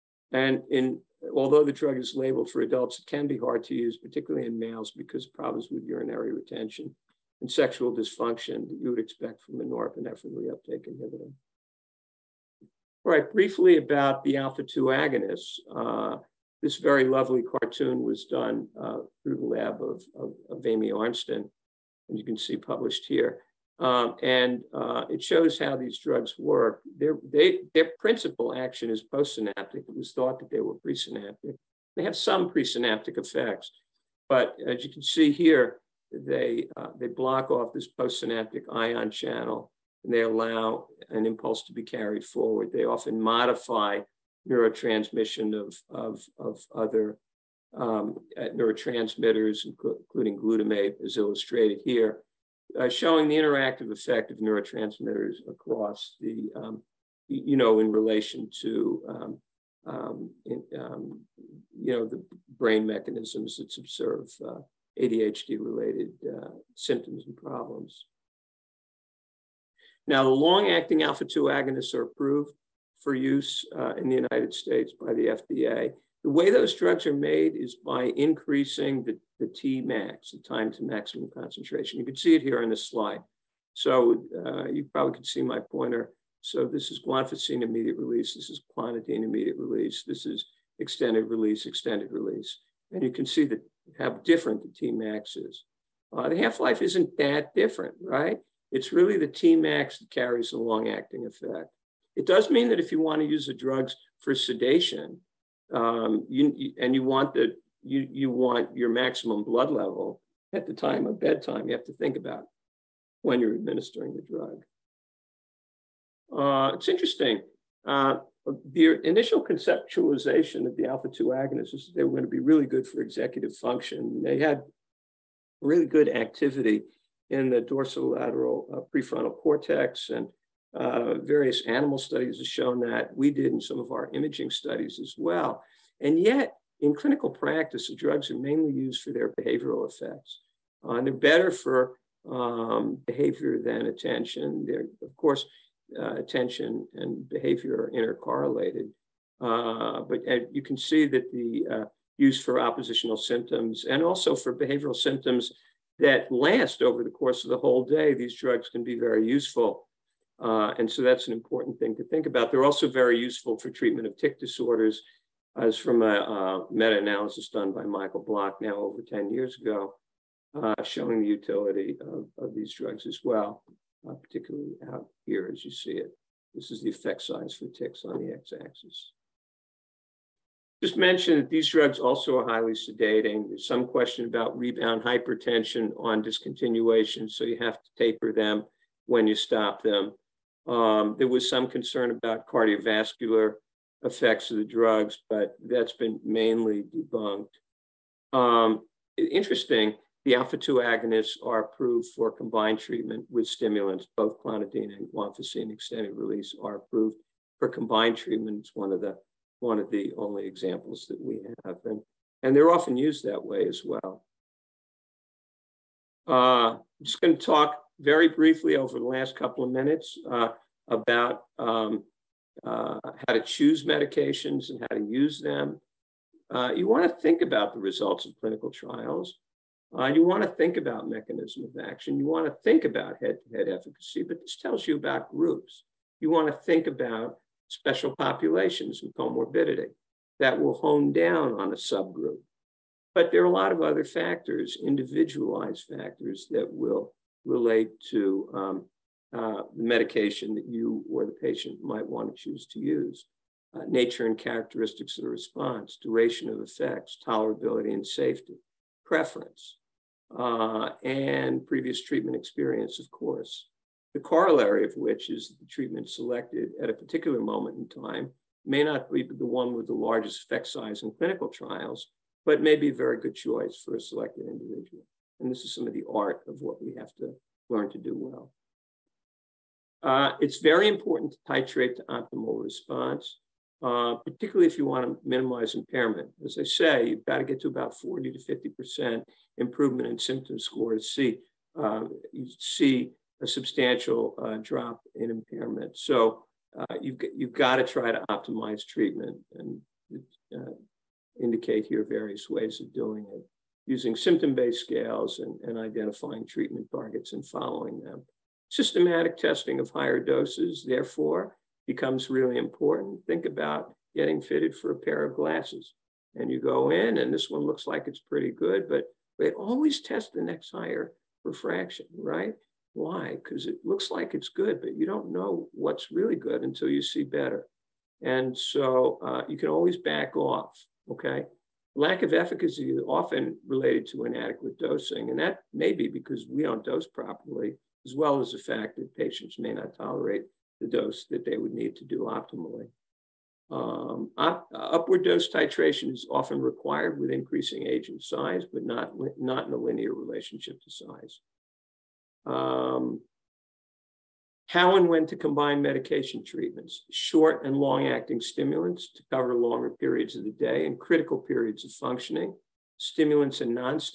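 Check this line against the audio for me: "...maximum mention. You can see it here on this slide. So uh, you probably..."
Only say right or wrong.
wrong.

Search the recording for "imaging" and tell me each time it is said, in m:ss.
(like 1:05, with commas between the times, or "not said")
2:14.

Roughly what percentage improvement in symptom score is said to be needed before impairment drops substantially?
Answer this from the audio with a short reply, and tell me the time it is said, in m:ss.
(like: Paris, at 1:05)
40 to 50%, at 4:47.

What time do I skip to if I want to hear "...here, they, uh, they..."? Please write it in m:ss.
0:35.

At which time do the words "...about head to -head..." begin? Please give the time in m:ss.
3:52.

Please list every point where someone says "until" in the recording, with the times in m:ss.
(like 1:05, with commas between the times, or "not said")
5:26.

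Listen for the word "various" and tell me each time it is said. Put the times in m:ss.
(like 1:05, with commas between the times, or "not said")
2:11, 5:02.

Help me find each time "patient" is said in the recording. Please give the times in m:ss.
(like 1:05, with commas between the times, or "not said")
4:11, 5:39.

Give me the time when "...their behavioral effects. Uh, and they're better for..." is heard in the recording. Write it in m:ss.
2:19.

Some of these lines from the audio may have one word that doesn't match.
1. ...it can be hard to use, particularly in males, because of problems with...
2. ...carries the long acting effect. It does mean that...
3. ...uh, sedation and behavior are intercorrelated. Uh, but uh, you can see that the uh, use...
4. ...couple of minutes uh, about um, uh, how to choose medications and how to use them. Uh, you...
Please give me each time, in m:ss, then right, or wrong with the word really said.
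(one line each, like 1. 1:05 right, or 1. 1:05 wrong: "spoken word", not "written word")
1. 0:02 right
2. 1:40 right
3. 2:25 wrong: "attention", not "sedation"
4. 3:39 right.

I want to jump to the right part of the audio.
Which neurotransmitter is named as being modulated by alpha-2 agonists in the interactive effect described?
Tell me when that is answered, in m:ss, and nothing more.
0:50.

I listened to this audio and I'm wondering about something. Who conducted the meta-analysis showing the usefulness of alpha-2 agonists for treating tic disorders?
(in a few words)
Michael Bloch.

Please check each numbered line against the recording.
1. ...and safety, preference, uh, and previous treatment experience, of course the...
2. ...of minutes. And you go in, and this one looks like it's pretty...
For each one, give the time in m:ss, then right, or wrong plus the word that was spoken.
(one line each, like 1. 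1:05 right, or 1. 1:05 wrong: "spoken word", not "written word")
1. 4:17 right
2. 5:15 wrong: "glasses", not "minutes".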